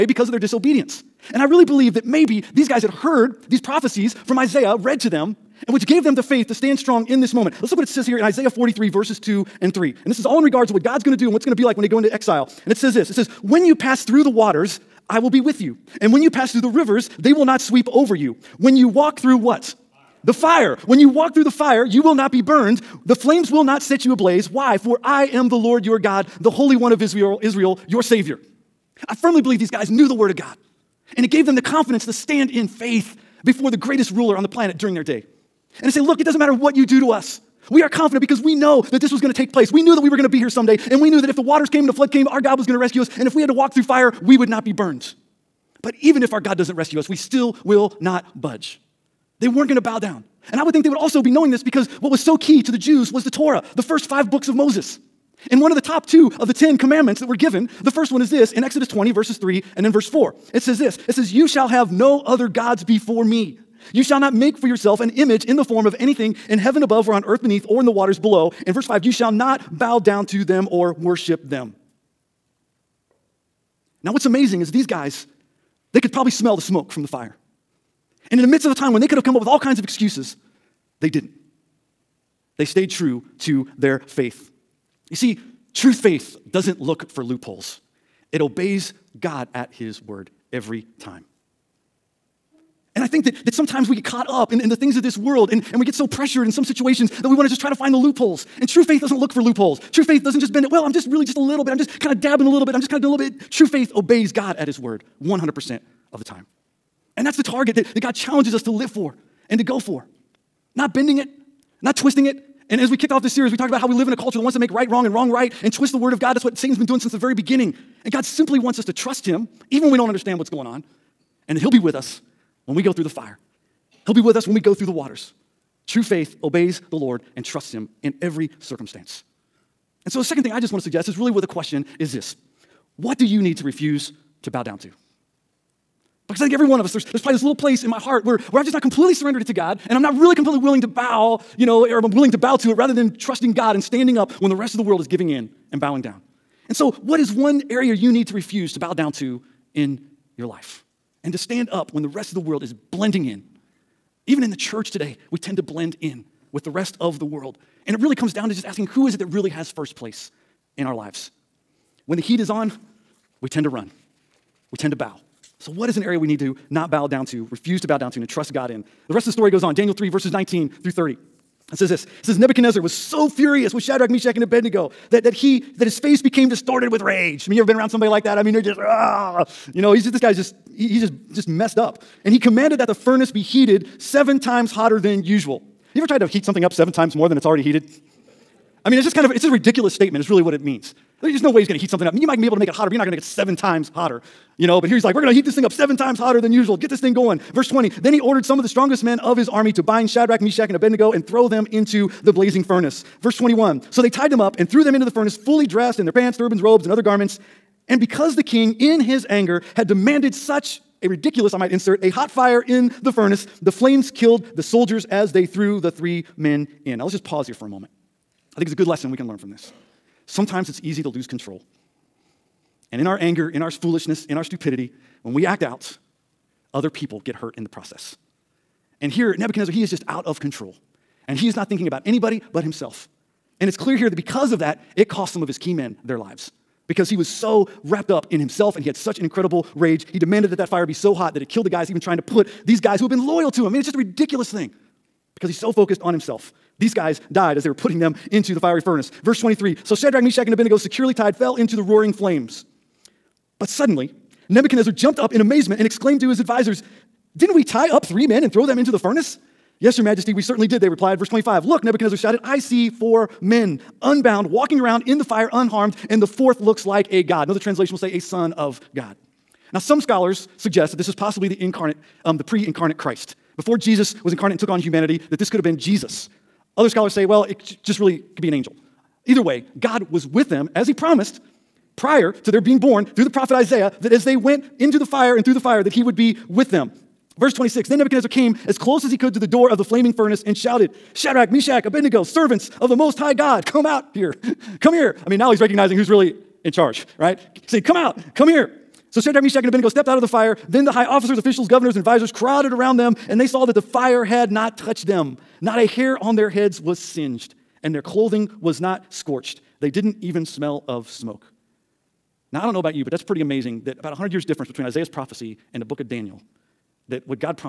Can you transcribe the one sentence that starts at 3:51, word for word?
And he is not thinking about anybody but himself.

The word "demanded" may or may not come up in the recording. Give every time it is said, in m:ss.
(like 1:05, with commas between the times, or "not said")
3:29, 4:00.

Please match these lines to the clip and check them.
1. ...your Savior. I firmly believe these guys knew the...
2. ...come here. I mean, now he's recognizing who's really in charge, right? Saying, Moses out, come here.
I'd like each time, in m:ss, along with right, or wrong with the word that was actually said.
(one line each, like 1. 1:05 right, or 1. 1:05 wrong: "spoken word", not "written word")
1. 0:27 right
2. 4:54 wrong: "Come", not "Moses".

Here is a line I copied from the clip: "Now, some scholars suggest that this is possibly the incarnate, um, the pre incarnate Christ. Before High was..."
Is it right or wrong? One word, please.
wrong.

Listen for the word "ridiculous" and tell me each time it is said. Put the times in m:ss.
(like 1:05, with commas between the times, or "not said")
3:09, 3:31, 4:03.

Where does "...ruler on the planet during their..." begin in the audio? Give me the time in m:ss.
0:34.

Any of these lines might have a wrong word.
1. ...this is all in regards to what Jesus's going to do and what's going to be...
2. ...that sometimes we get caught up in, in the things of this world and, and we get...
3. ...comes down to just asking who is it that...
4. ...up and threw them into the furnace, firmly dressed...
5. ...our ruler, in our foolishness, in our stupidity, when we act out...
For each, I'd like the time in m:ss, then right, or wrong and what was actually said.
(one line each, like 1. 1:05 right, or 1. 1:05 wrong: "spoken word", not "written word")
1. 0:10 wrong: "God", not "Jesus"
2. 1:33 right
3. 2:38 right
4. 3:24 wrong: "fully", not "firmly"
5. 3:43 wrong: "anger", not "ruler".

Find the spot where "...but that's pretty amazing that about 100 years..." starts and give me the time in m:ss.
5:13.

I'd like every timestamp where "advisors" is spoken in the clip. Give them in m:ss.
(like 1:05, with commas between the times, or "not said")
4:16, 5:01.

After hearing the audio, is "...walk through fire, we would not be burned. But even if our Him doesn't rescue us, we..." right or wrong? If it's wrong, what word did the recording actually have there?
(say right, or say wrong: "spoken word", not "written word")
wrong: "God", not "Him".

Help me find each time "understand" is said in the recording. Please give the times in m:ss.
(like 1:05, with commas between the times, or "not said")
2:00.